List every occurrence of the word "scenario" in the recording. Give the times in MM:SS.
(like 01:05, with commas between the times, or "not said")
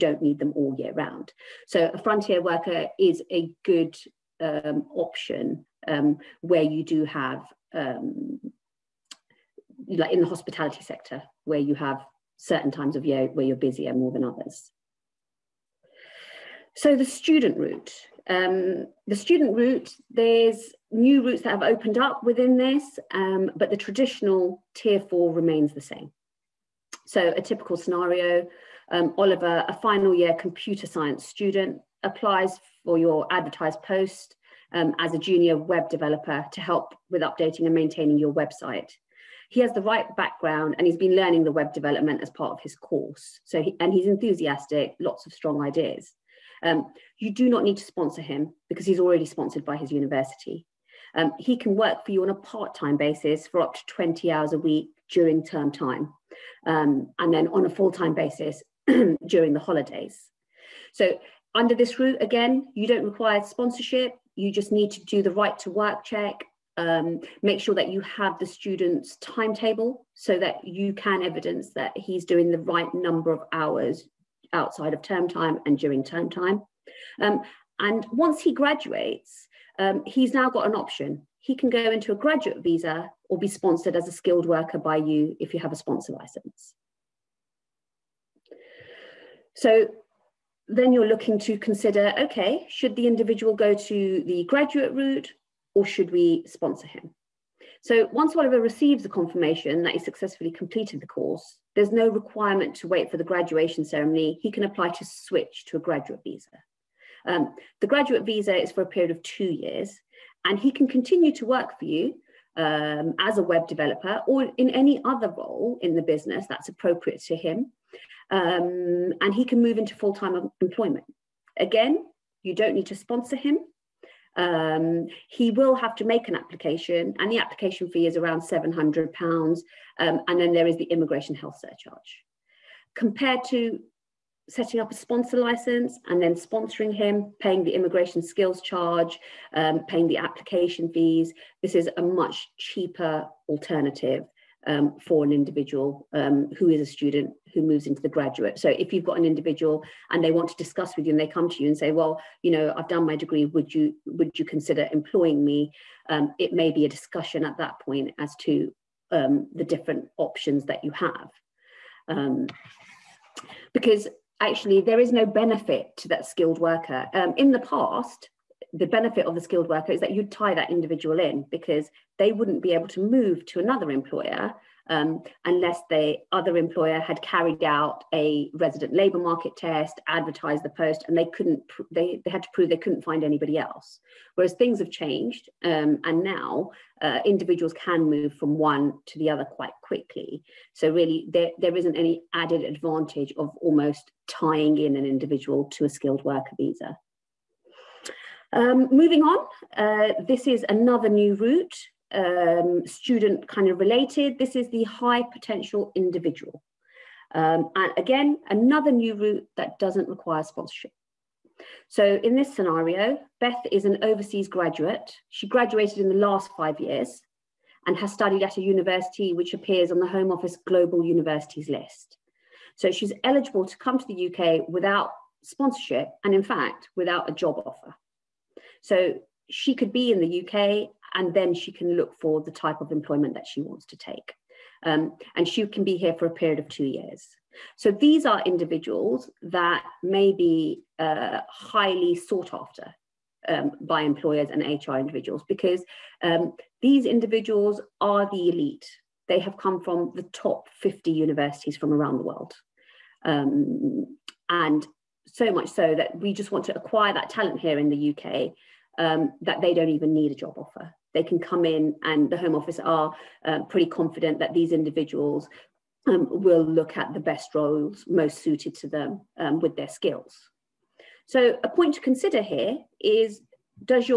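00:27, 03:32.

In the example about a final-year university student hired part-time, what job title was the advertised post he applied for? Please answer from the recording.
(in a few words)
Junior web developer.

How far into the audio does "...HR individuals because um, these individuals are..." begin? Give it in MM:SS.
04:04.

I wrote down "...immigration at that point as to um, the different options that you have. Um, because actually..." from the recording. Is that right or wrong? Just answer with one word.
wrong.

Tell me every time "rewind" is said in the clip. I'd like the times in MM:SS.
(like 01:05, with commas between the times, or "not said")
not said.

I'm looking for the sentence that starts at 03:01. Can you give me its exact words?
they they had to prove they couldn't find anybody else.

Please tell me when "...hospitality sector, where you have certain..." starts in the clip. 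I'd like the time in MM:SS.
00:10.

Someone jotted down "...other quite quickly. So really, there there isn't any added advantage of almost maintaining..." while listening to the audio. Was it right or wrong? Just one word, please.
wrong.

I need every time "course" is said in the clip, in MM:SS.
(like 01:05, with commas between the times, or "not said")
00:42, 01:41.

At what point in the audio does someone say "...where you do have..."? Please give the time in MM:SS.
00:06.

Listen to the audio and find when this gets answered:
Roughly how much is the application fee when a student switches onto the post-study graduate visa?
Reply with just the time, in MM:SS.
02:08.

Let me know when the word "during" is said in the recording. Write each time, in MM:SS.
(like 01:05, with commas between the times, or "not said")
00:55, 00:59, 01:15.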